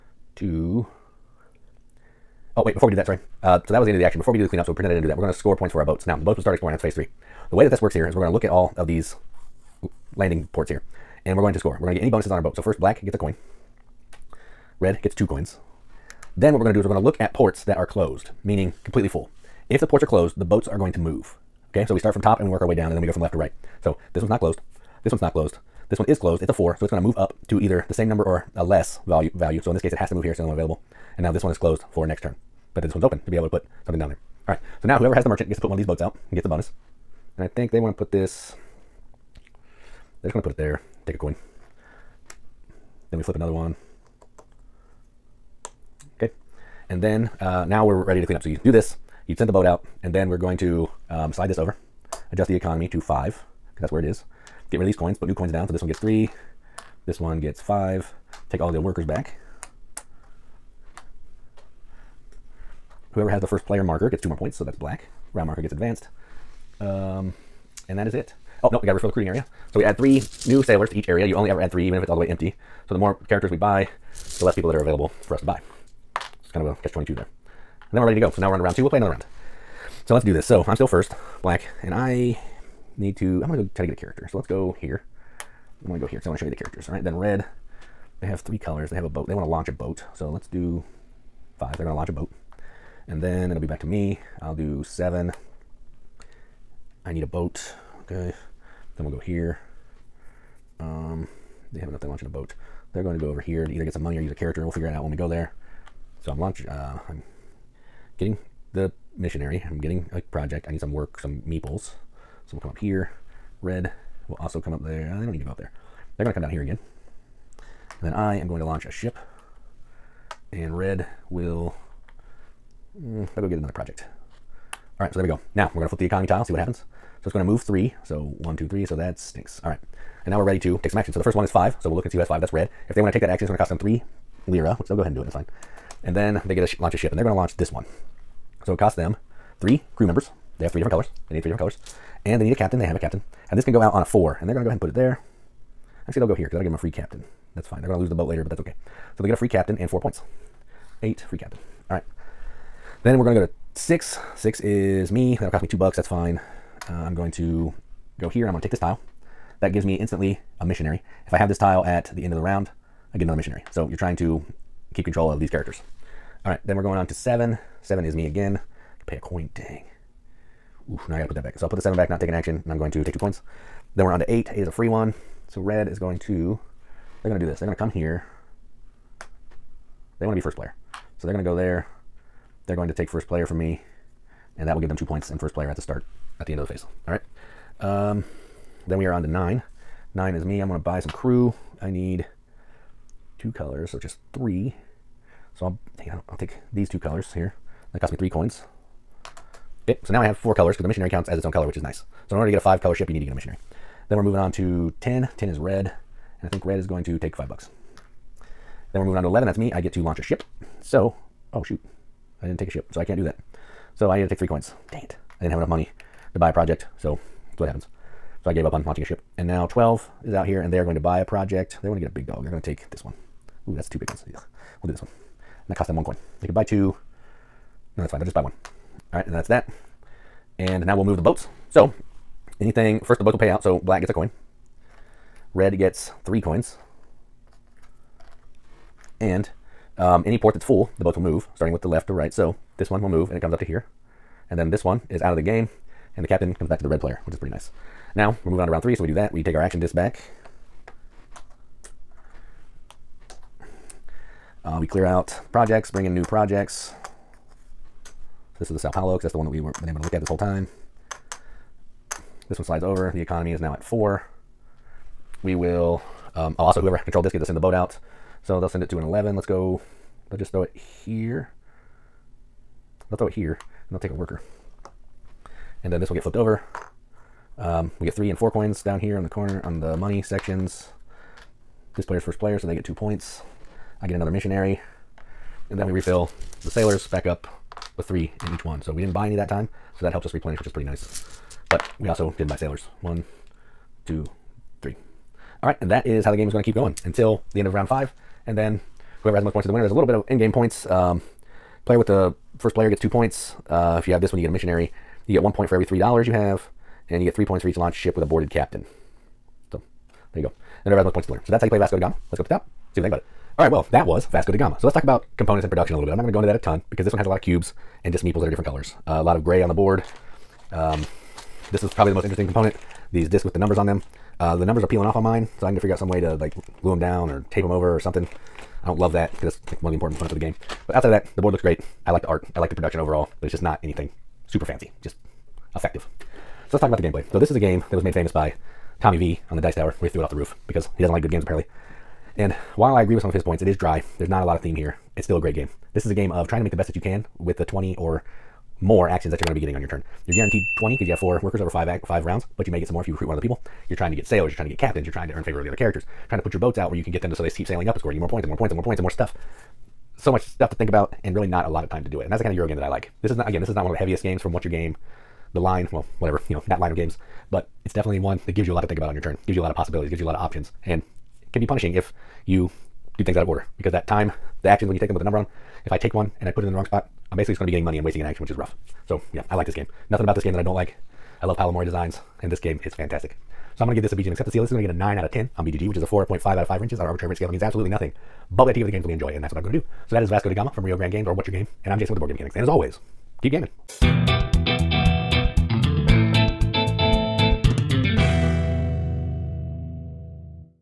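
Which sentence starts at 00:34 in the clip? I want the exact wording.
So now whoever has the merchant gets to put one of these boats out and gets the bonus.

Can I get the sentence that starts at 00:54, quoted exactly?
Get rid of these coins, put new coins down.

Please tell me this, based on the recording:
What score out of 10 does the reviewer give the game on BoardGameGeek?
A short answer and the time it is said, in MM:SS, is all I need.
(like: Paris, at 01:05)
9, at 06:24.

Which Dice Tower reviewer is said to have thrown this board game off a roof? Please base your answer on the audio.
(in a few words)
Tommy V.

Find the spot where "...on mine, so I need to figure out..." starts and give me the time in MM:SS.
05:25.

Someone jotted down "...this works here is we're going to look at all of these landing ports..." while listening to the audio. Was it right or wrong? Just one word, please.
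right.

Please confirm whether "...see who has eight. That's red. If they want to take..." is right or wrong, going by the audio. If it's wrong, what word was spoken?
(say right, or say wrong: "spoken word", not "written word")
wrong: "five", not "eight".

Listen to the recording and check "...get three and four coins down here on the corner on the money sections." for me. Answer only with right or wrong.
right.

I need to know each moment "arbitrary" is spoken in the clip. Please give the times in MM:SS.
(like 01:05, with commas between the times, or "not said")
06:27.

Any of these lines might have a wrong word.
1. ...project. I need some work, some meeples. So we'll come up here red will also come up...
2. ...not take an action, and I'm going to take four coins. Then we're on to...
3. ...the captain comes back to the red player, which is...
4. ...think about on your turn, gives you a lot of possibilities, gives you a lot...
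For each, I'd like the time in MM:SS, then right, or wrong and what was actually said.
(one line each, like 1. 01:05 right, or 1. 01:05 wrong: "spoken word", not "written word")
1. 01:50 right
2. 02:52 wrong: "two", not "four"
3. 04:06 right
4. 06:08 right.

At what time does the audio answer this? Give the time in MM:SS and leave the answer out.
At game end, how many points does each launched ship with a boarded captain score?
05:07.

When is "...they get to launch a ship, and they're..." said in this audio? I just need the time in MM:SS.
02:16.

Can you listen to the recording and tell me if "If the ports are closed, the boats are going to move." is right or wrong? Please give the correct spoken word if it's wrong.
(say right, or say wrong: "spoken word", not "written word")
right.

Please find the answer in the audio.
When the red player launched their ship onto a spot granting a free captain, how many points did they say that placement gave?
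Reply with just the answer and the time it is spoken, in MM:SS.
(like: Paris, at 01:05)
4, at 02:29.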